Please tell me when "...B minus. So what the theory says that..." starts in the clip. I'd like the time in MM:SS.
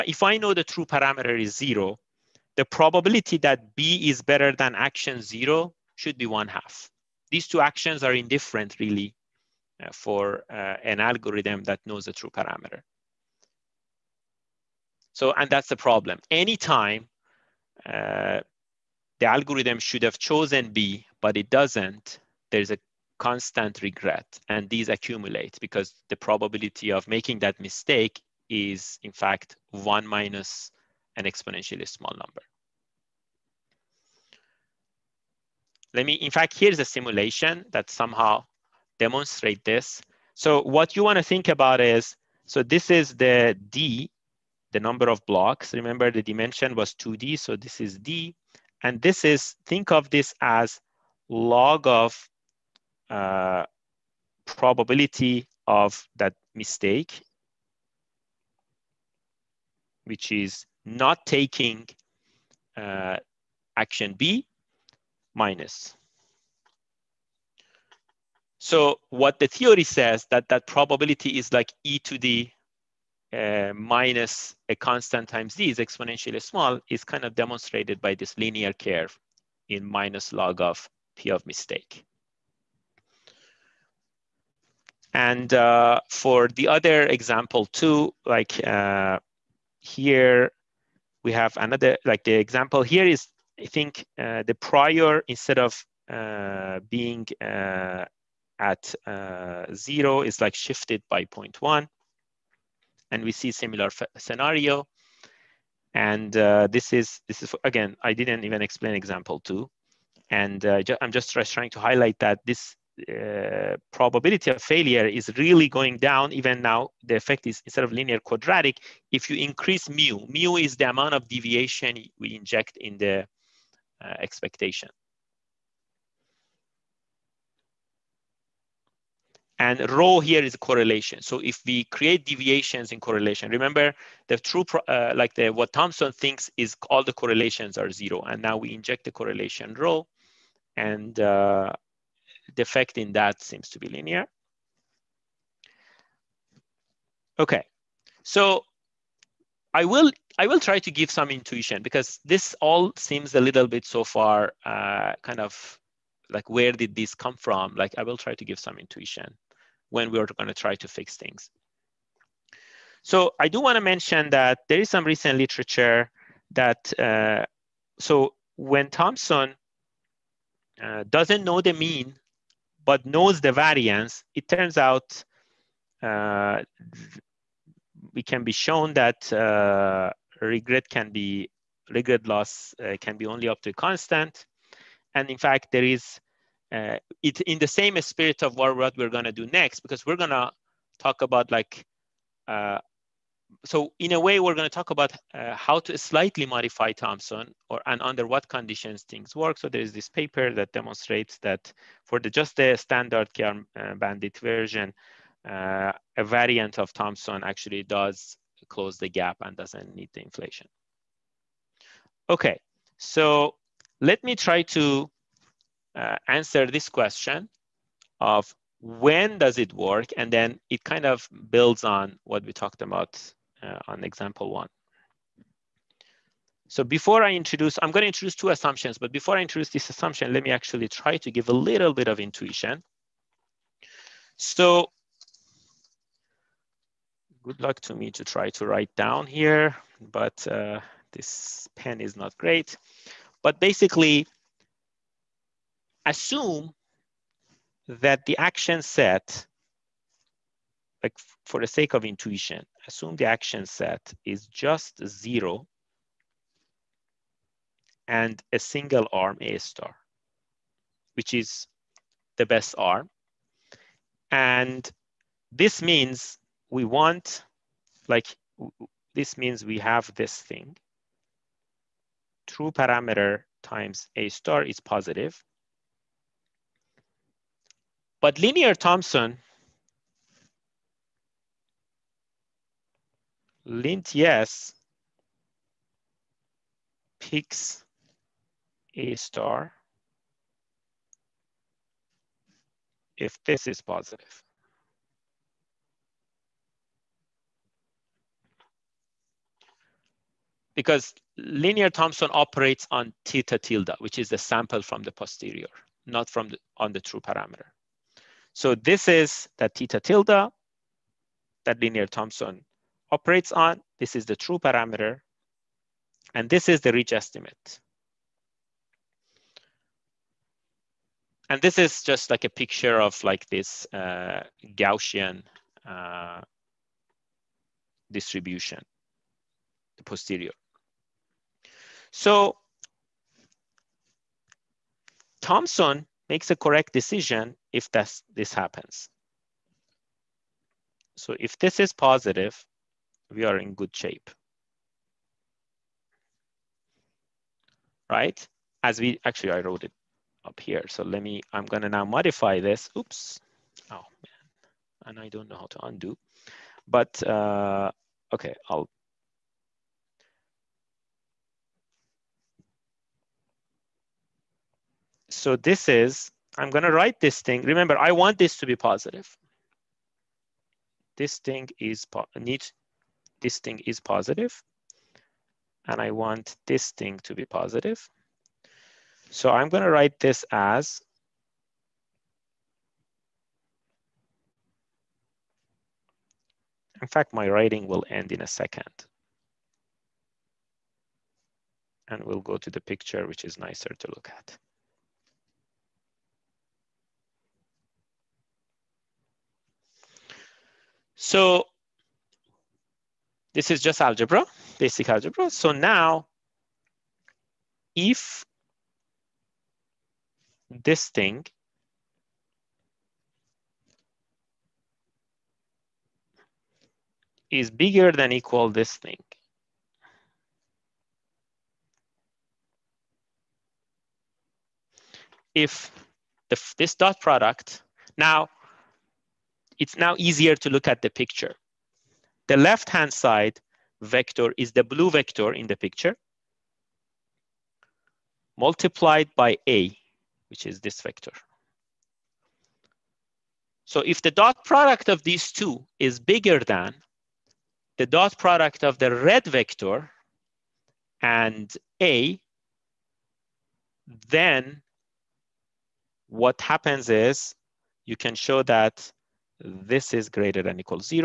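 01:04.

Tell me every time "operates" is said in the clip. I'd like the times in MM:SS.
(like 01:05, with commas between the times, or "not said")
05:02, 05:13.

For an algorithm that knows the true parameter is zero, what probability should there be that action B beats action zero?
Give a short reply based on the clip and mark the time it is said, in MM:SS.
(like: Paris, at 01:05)
one half, at 00:06.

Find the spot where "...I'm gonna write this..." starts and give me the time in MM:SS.
06:19.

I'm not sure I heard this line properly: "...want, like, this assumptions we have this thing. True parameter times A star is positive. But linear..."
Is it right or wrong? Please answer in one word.
wrong.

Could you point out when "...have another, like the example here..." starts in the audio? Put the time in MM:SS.
01:31.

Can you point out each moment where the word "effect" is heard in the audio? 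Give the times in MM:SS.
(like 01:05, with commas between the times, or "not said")
01:57, 02:22.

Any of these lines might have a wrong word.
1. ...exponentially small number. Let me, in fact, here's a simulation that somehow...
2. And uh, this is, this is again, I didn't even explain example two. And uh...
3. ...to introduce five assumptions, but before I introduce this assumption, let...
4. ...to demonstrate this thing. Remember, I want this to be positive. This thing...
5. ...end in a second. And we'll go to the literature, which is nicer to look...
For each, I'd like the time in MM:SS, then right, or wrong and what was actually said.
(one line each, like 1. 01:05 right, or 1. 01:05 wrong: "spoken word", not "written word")
1. 00:31 right
2. 01:45 right
3. 03:48 wrong: "two", not "five"
4. 06:06 wrong: "write", not "demonstrate"
5. 06:28 wrong: "picture", not "literature".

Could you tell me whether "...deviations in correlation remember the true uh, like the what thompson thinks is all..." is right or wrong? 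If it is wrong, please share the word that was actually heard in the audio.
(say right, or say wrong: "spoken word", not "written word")
right.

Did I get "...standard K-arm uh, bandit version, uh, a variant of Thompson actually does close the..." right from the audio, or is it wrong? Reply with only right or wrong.
right.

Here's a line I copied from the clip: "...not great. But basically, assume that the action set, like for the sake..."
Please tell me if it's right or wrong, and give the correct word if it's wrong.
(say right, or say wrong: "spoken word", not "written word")
right.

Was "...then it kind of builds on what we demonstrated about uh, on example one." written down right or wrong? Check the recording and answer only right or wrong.
wrong.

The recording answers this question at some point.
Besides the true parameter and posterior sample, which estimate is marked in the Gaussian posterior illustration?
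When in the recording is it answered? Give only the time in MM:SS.
05:16.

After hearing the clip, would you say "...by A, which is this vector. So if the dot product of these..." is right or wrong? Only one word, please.
right.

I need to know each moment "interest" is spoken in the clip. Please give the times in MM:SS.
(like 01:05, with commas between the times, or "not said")
not said.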